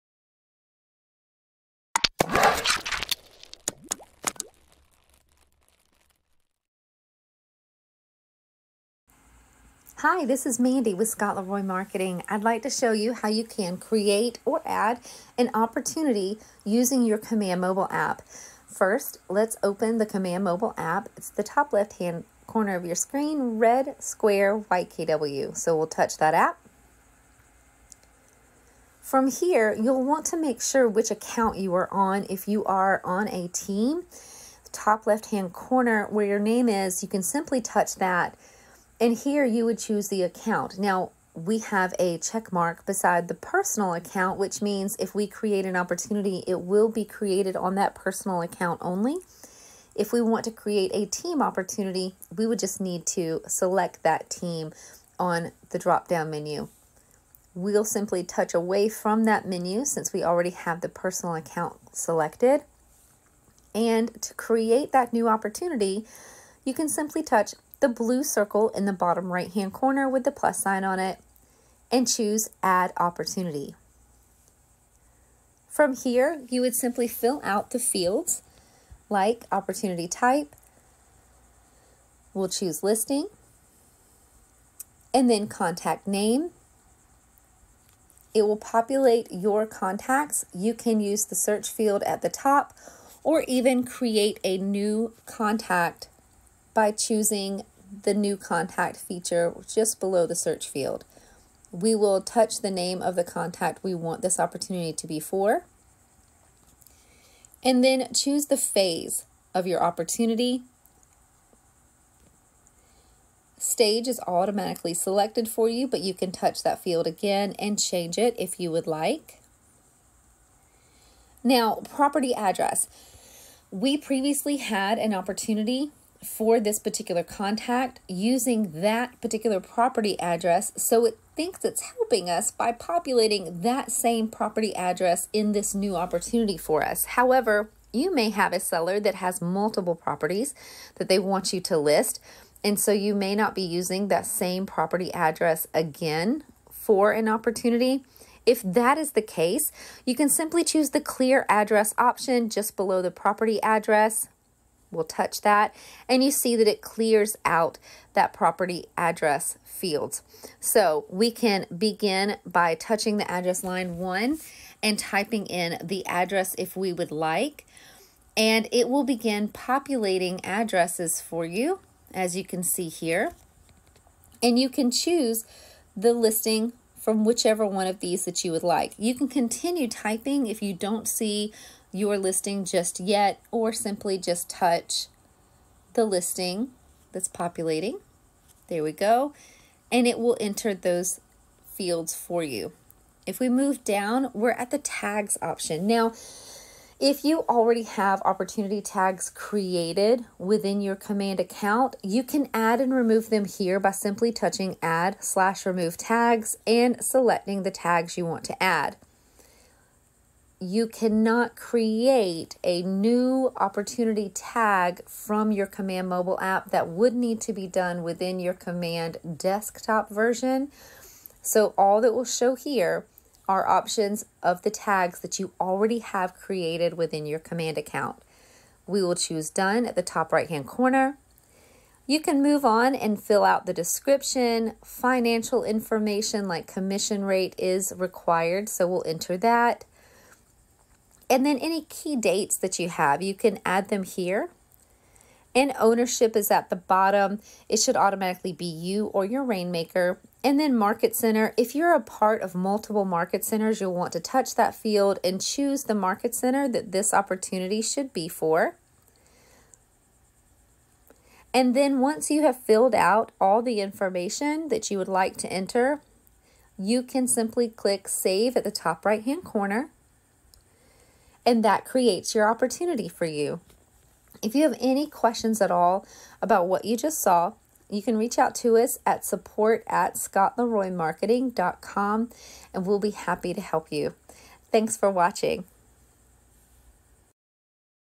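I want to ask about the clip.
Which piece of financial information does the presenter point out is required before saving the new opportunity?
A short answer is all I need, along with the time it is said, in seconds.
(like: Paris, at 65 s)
Commission rate, at 236 s.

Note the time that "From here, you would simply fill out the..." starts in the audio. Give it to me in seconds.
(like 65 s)
75 s.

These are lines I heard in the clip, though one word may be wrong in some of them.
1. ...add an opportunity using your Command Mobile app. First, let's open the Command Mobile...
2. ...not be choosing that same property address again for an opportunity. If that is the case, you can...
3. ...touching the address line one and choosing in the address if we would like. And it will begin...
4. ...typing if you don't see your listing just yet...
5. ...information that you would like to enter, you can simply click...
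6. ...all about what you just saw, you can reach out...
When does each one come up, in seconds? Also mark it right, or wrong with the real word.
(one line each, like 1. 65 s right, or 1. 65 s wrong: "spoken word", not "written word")
1. 14 s right
2. 143 s wrong: "using", not "choosing"
3. 162 s wrong: "typing", not "choosing"
4. 179 s right
5. 263 s right
6. 275 s right.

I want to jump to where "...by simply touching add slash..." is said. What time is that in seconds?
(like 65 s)
203 s.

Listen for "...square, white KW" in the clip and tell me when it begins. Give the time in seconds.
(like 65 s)
23 s.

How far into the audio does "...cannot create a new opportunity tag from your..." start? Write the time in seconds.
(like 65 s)
210 s.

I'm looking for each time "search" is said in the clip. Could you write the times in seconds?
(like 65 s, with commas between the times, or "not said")
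91 s, 100 s.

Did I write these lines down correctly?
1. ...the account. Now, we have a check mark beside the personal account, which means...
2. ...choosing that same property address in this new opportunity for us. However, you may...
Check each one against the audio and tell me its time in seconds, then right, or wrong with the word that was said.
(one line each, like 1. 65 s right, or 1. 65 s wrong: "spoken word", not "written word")
1. 40 s right
2. 132 s wrong: "populating", not "choosing".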